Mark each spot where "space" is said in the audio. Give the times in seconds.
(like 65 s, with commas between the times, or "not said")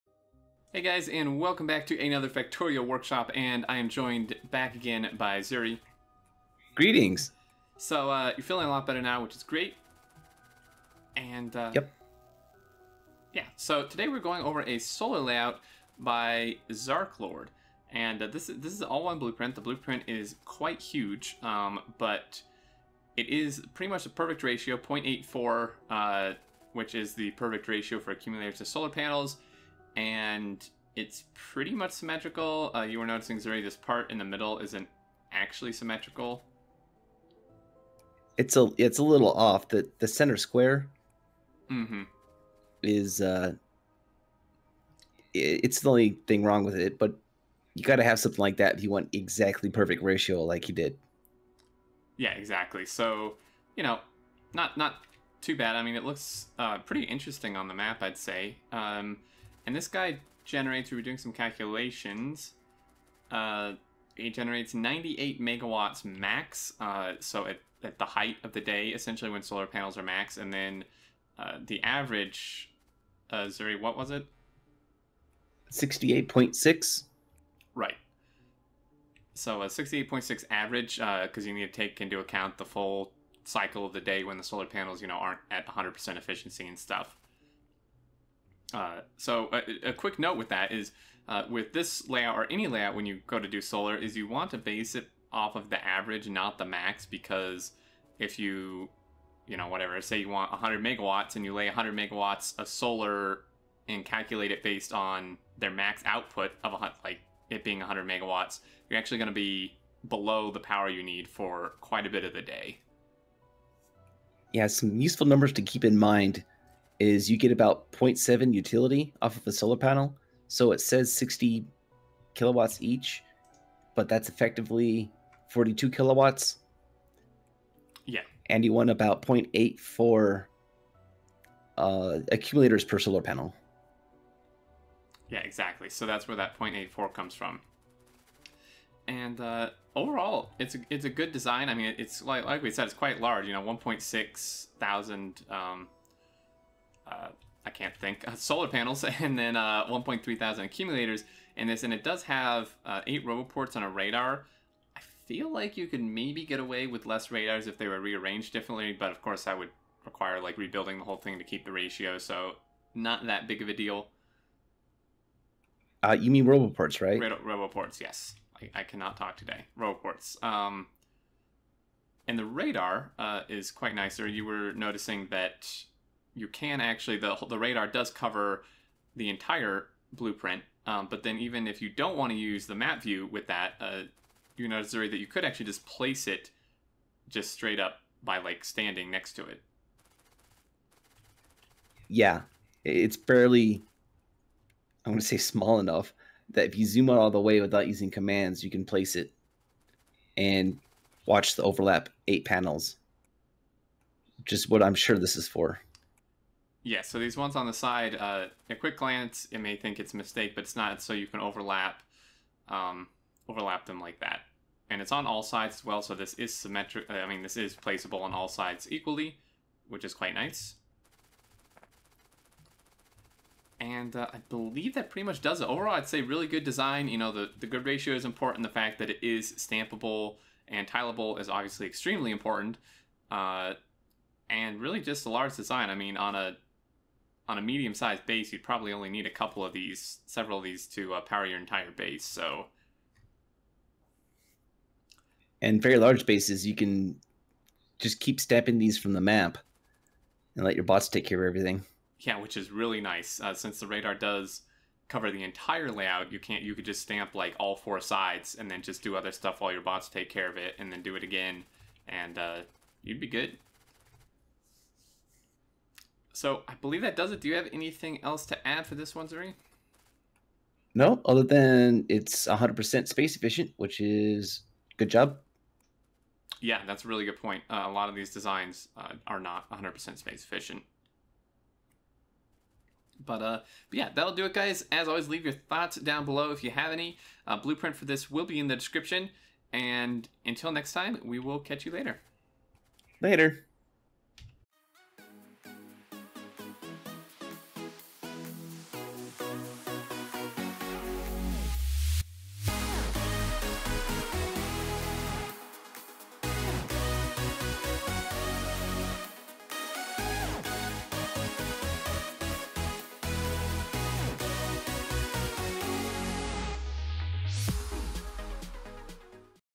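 273 s, 280 s.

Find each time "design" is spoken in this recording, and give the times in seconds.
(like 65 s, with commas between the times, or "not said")
141 s, 226 s, 235 s, 278 s.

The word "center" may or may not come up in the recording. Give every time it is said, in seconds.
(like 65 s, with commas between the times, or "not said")
40 s.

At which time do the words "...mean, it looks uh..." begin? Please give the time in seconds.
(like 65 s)
55 s.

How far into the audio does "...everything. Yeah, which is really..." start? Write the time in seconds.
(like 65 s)
251 s.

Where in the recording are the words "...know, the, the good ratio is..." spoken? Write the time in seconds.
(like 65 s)
227 s.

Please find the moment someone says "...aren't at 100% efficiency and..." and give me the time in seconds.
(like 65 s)
85 s.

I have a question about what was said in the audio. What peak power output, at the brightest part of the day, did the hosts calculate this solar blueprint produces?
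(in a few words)
98 megawatts.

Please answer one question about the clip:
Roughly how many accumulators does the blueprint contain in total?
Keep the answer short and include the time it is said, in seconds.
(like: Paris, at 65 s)
1.3 thousand, at 149 s.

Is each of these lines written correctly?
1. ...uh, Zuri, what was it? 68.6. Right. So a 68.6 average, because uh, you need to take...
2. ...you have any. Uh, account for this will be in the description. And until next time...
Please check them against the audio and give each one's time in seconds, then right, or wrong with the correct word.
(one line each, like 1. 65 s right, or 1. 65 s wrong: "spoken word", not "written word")
1. 73 s right
2. 286 s wrong: "blueprint", not "account".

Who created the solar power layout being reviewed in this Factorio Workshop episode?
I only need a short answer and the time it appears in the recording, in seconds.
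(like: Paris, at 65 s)
Zarklord, at 16 s.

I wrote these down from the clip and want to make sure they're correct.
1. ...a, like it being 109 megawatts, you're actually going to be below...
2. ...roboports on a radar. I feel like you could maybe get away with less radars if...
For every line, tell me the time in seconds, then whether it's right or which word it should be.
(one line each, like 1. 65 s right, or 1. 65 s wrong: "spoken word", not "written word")
1. 106 s wrong: "100", not "109"
2. 153 s right.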